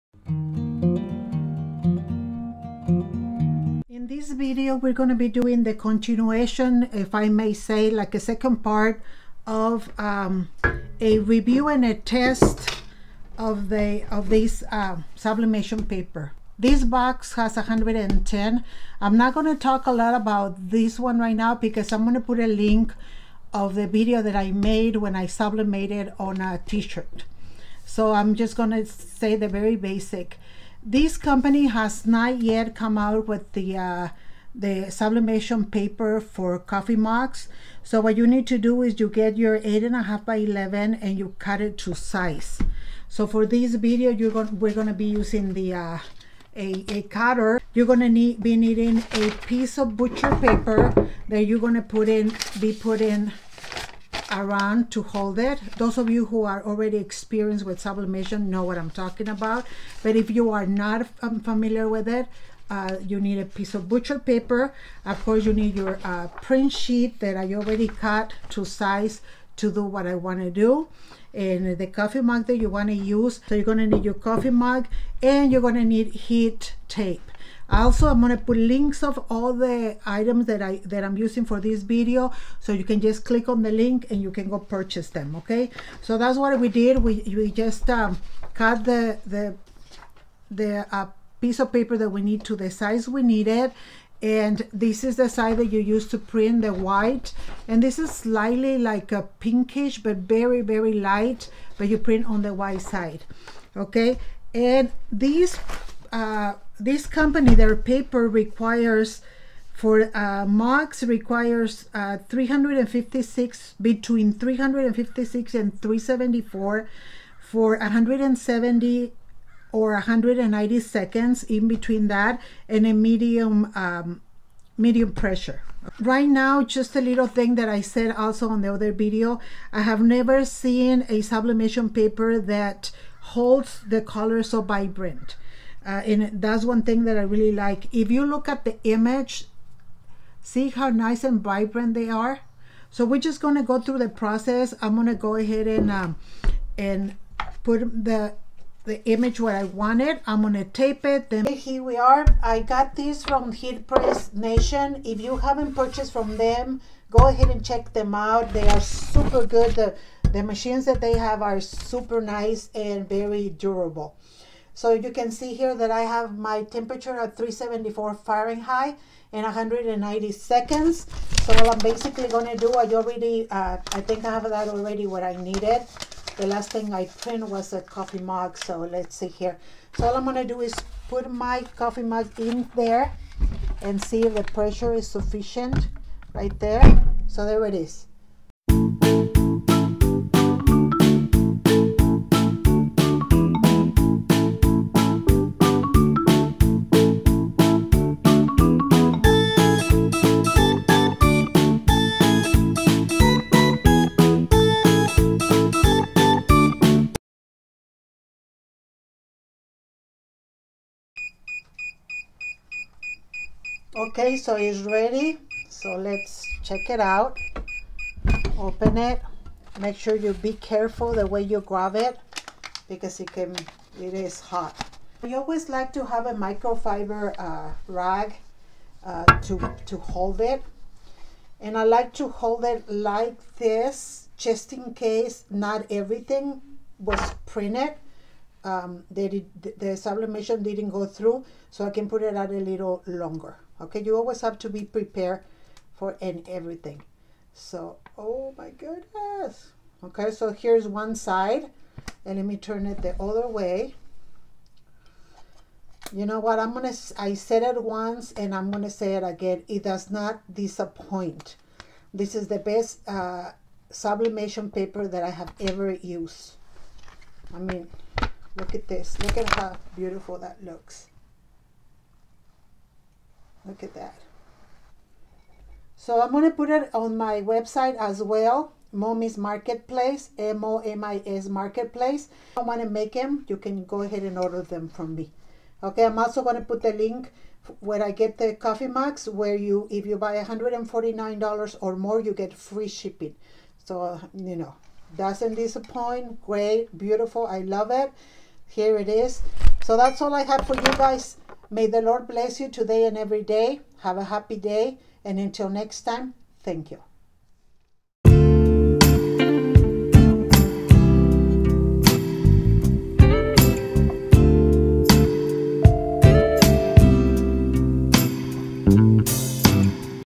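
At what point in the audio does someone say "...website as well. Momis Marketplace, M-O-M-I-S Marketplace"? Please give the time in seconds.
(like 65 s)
277 s.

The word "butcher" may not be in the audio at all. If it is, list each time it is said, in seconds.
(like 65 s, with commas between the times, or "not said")
49 s, 63 s.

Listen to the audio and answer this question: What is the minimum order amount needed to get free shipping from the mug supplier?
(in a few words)
$149.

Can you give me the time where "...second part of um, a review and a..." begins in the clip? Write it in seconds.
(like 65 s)
8 s.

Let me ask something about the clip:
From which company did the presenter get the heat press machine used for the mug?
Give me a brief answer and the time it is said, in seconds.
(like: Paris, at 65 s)
Heat Press Nation, at 153 s.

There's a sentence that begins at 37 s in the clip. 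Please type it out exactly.
So what you need to do is you get your eight and a half by 11 and you cut it to size.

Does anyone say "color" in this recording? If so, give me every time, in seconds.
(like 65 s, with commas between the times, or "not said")
134 s.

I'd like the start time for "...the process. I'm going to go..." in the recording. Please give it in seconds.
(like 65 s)
143 s.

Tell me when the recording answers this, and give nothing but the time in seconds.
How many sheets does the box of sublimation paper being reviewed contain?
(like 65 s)
17 s.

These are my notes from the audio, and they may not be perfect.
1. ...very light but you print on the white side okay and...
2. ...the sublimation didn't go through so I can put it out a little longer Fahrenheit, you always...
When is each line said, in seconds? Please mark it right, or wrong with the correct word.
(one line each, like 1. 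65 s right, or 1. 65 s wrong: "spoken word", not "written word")
1. 100 s right
2. 239 s wrong: "Okay", not "Fahrenheit".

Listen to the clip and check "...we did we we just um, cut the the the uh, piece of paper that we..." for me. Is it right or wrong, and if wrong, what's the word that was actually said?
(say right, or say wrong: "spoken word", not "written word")
right.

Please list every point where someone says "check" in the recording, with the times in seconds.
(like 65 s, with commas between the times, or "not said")
157 s, 216 s.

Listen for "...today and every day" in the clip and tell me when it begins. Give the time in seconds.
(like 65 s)
302 s.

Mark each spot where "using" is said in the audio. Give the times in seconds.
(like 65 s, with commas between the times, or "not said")
45 s, 81 s.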